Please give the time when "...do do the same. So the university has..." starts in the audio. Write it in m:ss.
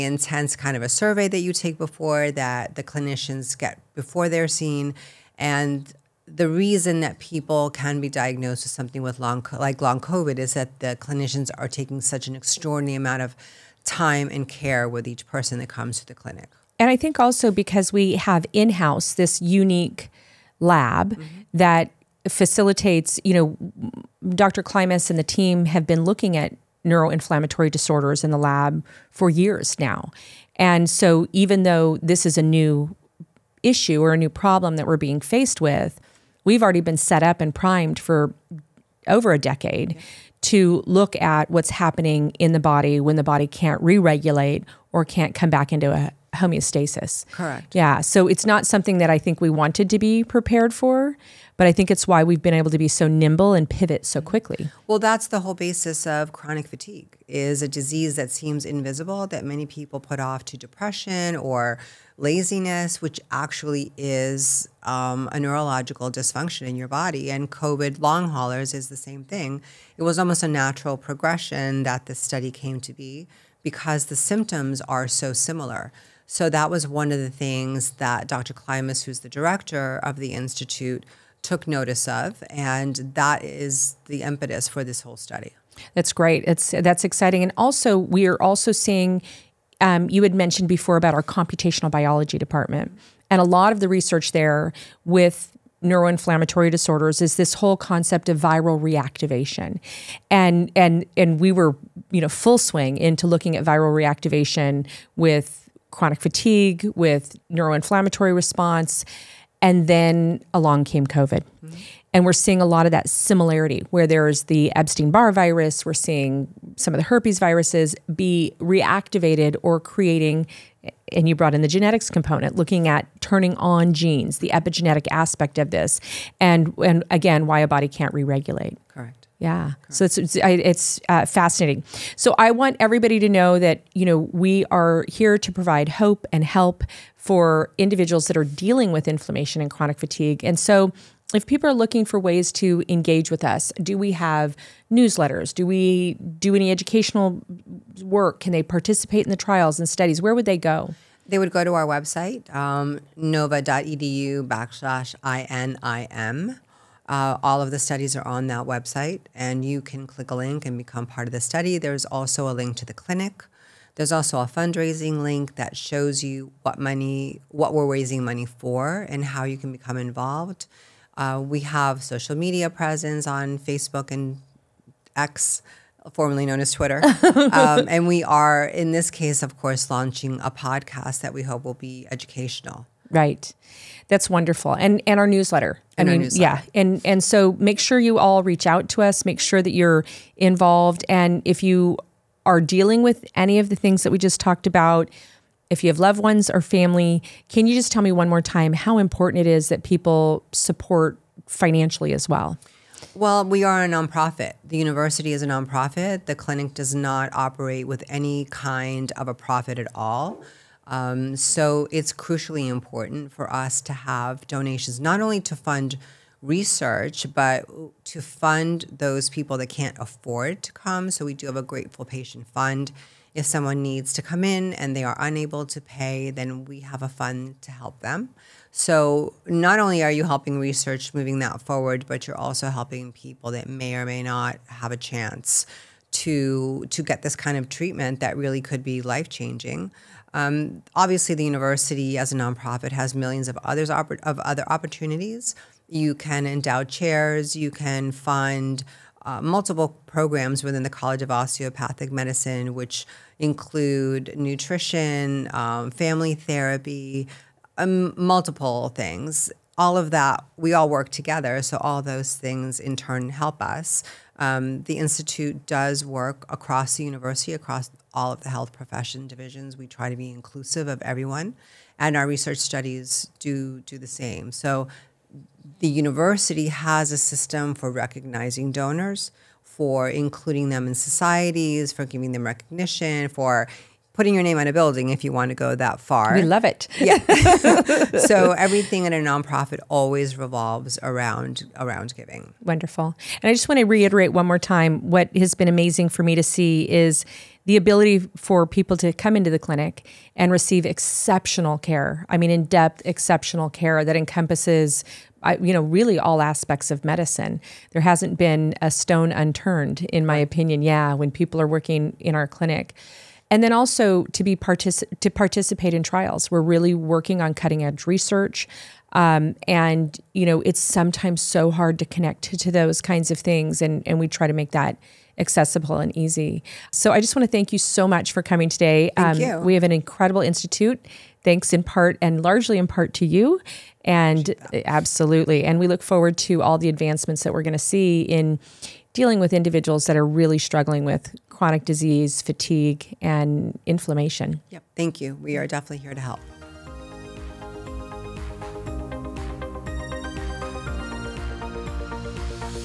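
4:33.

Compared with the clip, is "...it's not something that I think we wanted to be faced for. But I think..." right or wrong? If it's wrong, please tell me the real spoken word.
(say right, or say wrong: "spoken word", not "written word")
wrong: "prepared", not "faced".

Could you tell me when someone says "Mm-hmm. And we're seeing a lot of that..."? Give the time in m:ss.
1:51.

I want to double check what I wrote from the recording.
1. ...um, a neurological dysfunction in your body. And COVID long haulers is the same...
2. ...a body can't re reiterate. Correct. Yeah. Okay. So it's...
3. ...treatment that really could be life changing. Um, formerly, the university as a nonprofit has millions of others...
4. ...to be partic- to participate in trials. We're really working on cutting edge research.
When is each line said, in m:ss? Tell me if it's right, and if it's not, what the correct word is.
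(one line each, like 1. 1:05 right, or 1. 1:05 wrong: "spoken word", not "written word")
1. 1:04 right
2. 2:07 wrong: "regulate", not "reiterate"
3. 3:57 wrong: "obviously", not "formerly"
4. 5:14 right.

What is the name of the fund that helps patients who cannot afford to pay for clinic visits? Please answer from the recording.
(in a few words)
grateful patient fund.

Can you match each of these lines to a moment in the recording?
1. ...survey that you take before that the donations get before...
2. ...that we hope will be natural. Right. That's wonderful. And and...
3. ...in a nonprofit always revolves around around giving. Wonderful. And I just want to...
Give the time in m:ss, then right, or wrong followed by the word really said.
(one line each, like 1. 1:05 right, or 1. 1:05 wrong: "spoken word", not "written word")
1. 0:00 wrong: "clinicians", not "donations"
2. 3:01 wrong: "educational", not "natural"
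3. 4:49 right.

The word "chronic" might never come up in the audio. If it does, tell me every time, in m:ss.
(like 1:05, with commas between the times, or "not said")
0:56, 1:45, 2:19, 5:41.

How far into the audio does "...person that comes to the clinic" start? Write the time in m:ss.
0:15.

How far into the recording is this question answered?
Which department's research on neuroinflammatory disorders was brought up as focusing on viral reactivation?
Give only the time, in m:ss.
1:31.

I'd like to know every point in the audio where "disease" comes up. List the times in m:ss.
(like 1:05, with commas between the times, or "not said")
0:57, 5:41.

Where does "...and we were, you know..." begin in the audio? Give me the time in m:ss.
1:41.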